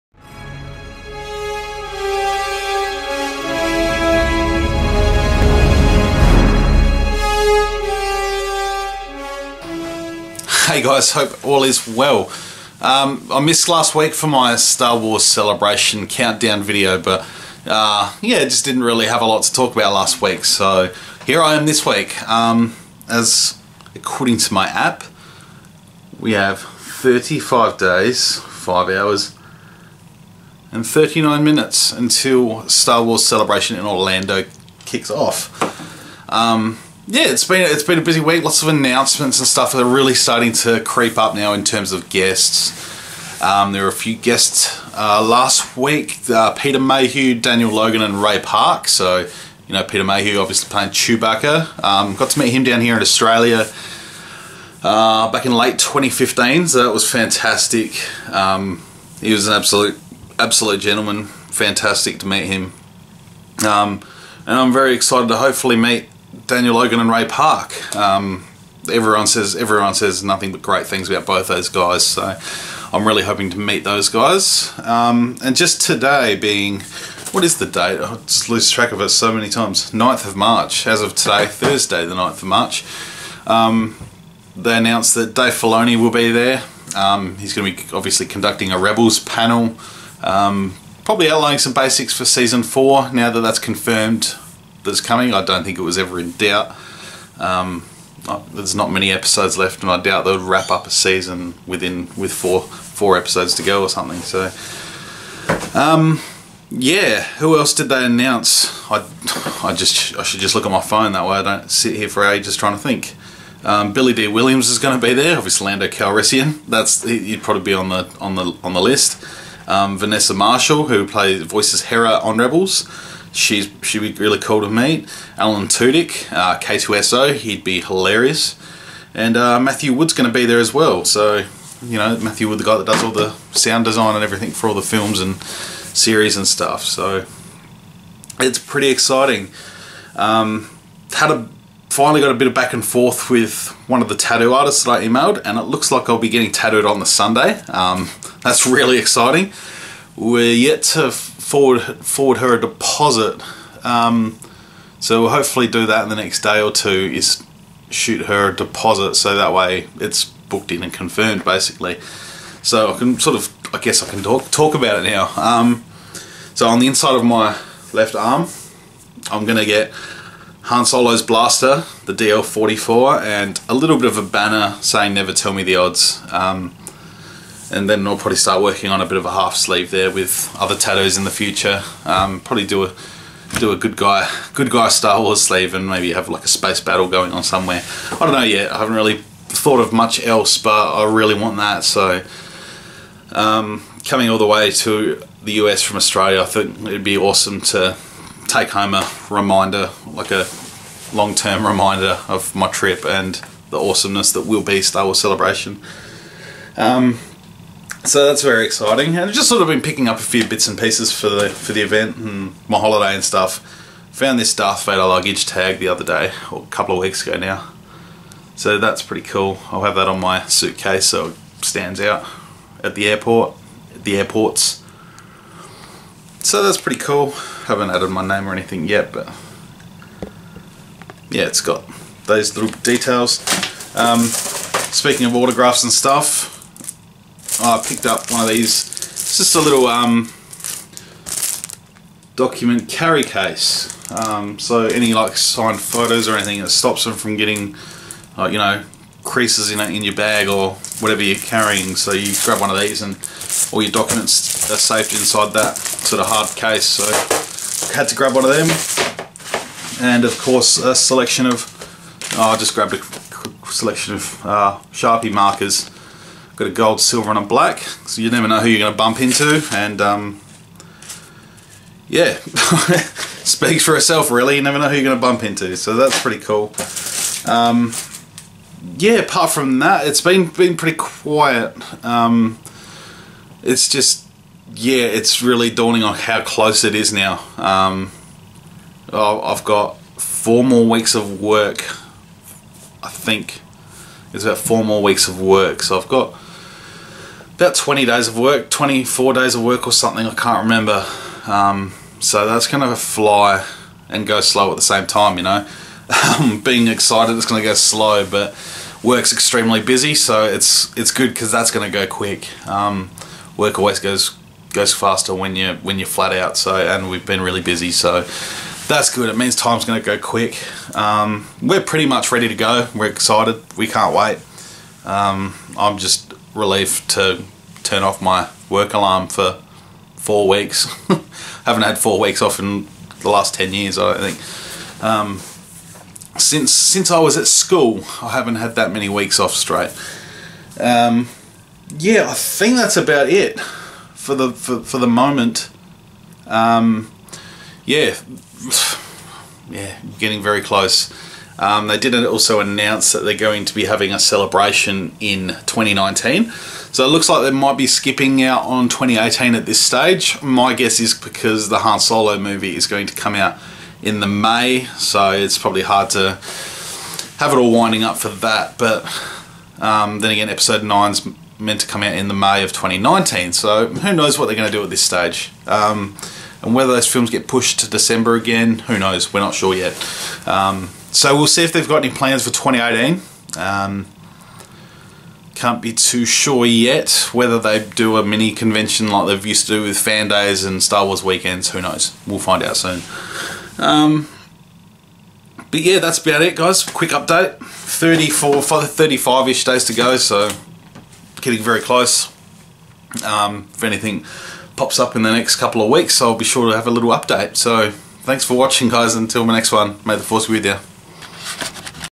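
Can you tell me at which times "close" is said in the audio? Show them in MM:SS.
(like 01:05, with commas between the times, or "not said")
04:46, 05:50, 06:41.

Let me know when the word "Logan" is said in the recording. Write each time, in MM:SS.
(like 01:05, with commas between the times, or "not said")
00:47, 01:06.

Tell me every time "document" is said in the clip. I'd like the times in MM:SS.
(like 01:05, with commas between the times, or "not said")
04:02, 04:13.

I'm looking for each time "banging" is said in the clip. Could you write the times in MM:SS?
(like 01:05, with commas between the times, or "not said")
not said.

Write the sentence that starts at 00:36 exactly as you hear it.
Um, yeah, it's been it's been a busy week.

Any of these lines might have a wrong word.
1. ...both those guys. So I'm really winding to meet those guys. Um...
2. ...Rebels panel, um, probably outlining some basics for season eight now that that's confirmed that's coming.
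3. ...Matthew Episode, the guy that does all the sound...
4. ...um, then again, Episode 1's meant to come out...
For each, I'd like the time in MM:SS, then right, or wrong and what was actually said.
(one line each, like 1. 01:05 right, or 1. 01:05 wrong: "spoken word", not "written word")
1. 01:11 wrong: "hoping", not "winding"
2. 01:28 wrong: "four", not "eight"
3. 02:12 wrong: "Wood", not "Episode"
4. 06:09 wrong: "9", not "1".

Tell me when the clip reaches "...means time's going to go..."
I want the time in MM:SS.
05:19.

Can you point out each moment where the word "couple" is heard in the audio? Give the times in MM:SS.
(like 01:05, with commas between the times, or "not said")
03:36, 06:45.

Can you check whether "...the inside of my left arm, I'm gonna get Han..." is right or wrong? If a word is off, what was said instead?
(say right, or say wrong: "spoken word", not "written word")
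right.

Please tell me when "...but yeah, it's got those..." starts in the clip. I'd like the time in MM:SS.
03:49.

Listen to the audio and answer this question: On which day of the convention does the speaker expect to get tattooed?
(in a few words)
Sunday.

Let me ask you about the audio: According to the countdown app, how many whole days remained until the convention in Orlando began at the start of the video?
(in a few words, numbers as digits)
35.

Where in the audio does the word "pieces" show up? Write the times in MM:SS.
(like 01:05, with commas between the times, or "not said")
03:30.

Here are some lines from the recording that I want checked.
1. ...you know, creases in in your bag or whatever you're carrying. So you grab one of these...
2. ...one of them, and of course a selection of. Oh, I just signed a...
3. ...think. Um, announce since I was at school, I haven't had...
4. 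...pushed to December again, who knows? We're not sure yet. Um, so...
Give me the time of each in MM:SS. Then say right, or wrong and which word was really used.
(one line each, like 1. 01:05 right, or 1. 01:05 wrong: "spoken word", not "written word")
1. 04:08 right
2. 04:18 wrong: "grabbed", not "signed"
3. 05:34 wrong: "since", not "announce"
4. 06:17 right.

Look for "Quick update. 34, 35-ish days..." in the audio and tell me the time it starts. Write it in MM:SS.
06:36.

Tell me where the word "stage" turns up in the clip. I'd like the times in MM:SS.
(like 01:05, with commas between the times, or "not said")
05:59, 06:15.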